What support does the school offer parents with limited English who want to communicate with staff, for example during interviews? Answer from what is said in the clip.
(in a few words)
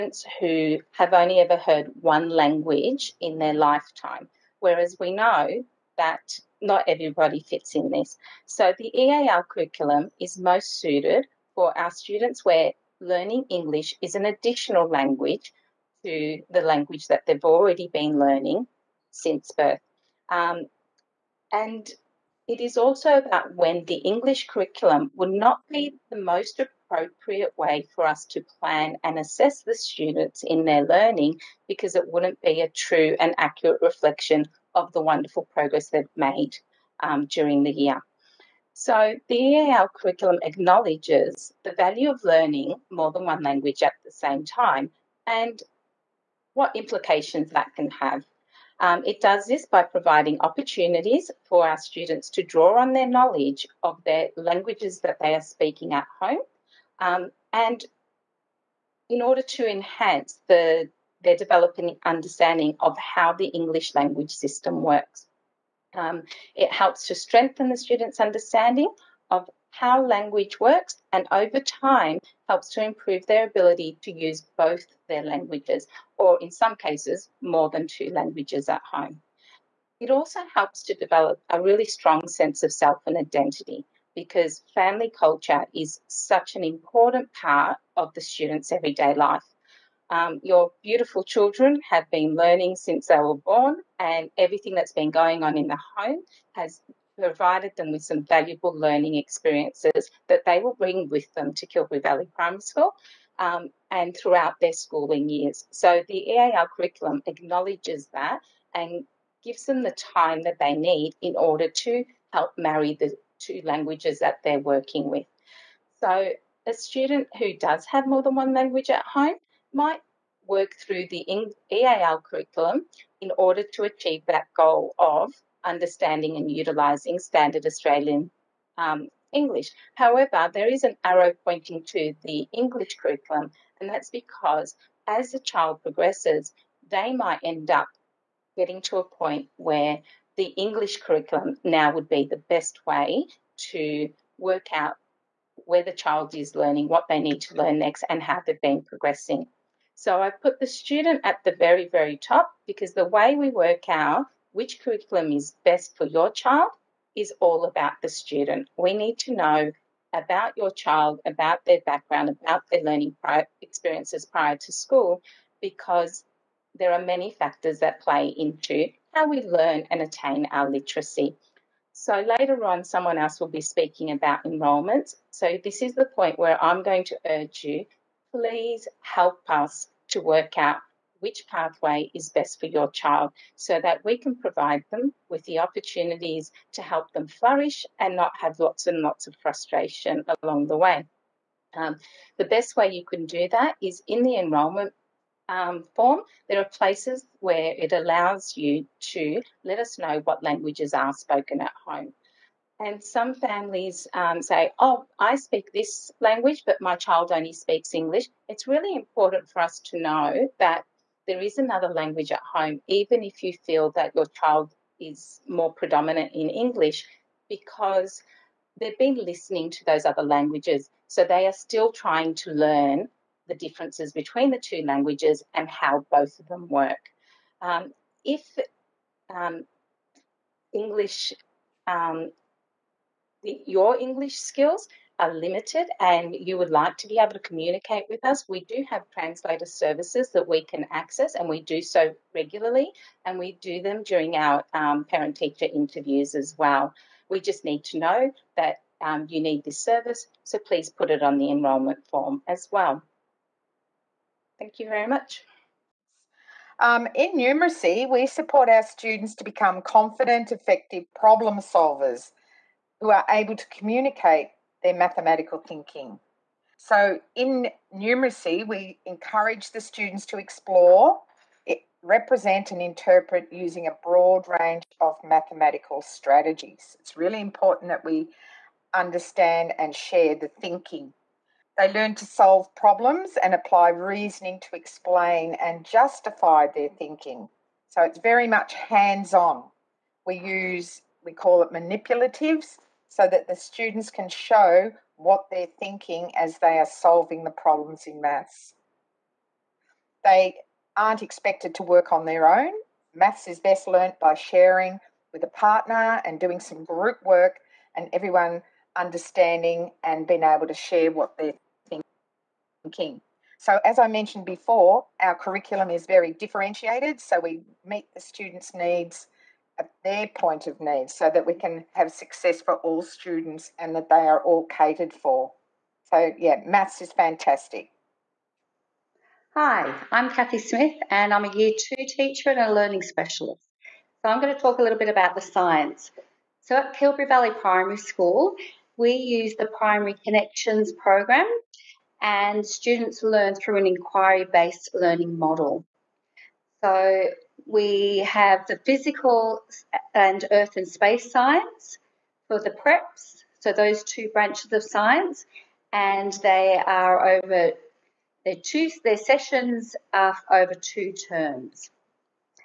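translator services.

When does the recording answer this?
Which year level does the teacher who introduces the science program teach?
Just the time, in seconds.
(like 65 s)
331 s.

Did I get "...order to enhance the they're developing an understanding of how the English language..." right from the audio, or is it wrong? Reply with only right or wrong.
right.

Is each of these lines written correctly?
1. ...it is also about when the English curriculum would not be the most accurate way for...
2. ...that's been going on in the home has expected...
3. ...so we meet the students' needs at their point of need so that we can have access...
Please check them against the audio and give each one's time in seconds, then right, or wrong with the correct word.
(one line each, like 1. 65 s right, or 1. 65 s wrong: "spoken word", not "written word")
1. 22 s wrong: "appropriate", not "accurate"
2. 94 s wrong: "provided", not "expected"
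3. 317 s wrong: "success", not "access".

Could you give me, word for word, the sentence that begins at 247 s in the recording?
We just need to know that um, you need this service, so please put it on the enrolment form as well.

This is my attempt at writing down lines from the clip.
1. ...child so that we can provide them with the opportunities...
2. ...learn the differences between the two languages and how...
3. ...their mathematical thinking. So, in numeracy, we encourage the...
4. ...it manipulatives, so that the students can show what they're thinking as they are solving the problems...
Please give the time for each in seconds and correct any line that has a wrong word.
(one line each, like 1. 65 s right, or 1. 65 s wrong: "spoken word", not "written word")
1. 182 s right
2. 222 s right
3. 264 s right
4. 291 s right.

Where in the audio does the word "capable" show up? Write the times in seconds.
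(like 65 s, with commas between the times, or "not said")
not said.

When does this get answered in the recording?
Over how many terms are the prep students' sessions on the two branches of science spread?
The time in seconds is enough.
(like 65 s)
360 s.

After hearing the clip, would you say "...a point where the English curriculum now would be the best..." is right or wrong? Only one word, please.
right.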